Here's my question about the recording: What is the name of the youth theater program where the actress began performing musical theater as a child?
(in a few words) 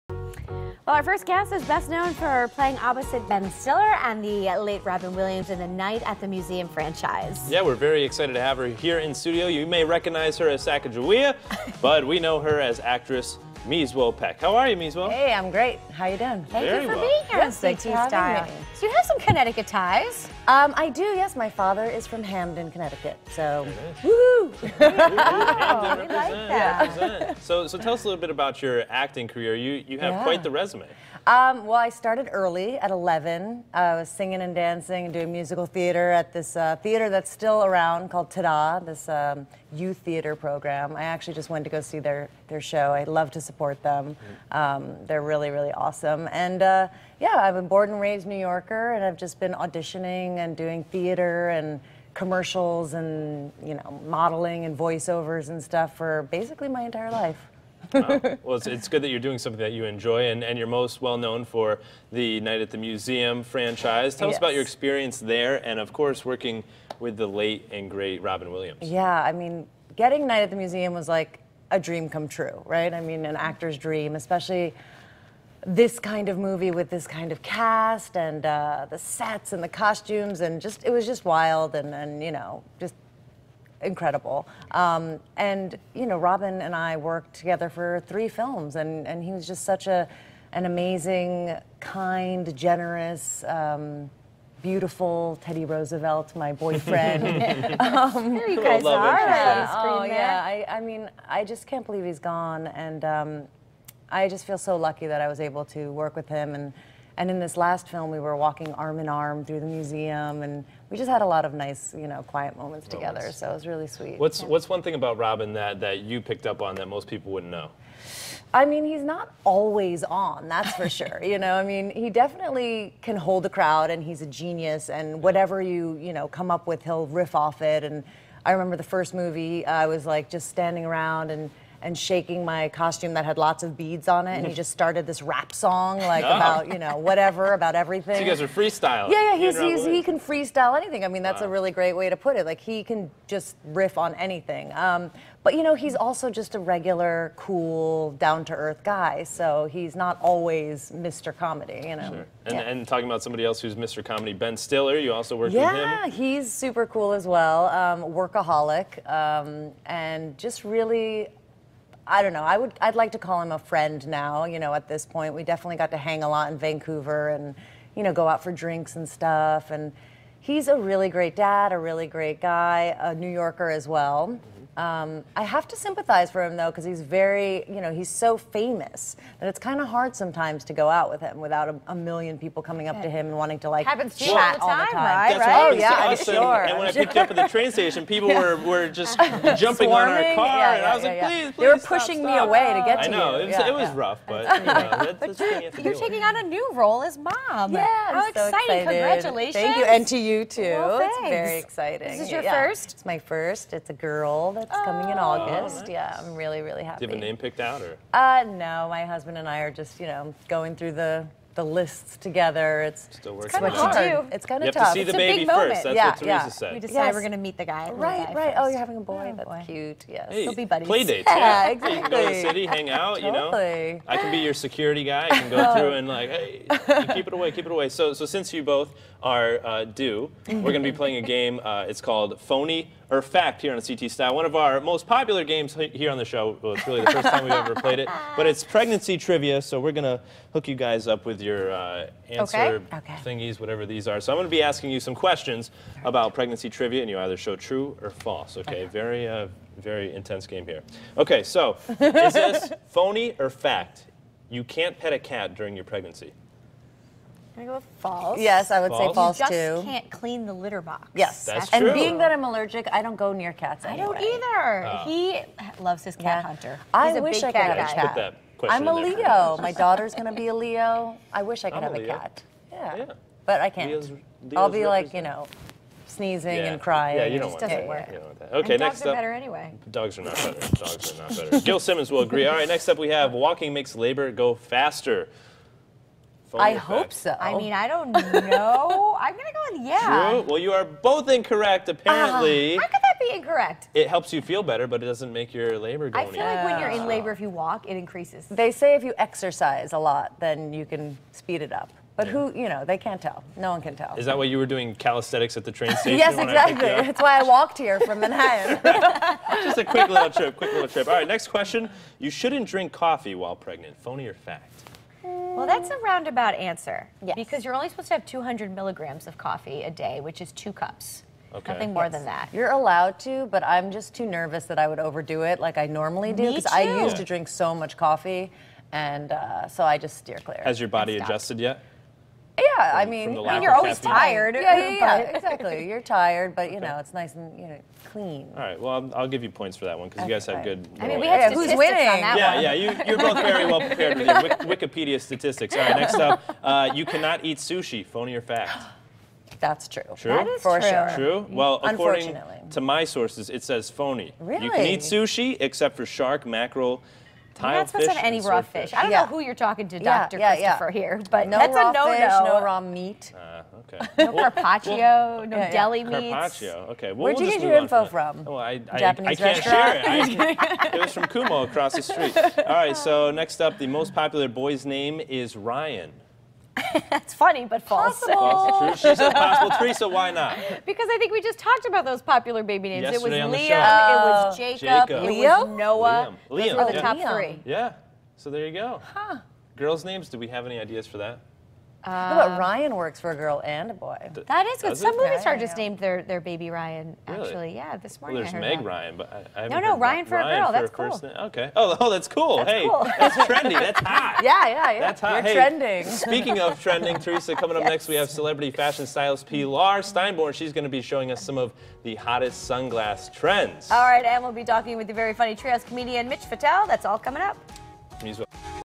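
Tada.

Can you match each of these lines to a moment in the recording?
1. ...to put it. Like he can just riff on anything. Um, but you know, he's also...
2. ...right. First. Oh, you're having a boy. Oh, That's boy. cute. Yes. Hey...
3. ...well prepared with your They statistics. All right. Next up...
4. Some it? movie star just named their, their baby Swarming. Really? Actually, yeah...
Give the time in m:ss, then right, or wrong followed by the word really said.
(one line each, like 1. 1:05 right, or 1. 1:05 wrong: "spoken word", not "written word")
1. 2:22 right
2. 3:38 right
3. 5:43 wrong: "Wikipedia", not "They"
4. 6:34 wrong: "Ryan", not "Swarming".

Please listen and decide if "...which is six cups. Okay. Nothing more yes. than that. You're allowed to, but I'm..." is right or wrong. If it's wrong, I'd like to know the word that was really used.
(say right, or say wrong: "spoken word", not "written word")
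wrong: "two", not "six".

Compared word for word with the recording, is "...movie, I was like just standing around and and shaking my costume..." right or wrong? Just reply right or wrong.
right.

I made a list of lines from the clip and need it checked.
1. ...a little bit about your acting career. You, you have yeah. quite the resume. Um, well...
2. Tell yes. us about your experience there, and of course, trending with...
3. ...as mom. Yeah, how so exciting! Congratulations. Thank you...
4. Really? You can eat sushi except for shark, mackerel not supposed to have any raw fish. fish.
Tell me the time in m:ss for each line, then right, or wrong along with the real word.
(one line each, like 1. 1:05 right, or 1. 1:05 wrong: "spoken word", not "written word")
1. 0:28 right
2. 1:04 wrong: "working", not "trending"
3. 3:17 right
4. 5:54 right.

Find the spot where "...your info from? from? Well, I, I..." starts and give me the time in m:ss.
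6:07.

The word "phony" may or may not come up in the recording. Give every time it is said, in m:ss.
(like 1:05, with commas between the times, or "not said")
3:52, 4:12, 5:13, 5:48, 5:53.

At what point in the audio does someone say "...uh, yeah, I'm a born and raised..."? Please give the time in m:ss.
0:46.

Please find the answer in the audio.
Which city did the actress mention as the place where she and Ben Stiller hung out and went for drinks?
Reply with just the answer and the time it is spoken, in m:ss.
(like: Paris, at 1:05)
Vancouver, at 2:46.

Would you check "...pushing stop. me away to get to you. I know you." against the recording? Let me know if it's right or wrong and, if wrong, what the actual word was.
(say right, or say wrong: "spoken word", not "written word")
right.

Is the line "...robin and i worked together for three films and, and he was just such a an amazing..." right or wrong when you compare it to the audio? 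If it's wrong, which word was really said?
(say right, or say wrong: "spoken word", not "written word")
right.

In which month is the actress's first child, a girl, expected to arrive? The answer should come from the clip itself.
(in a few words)
August.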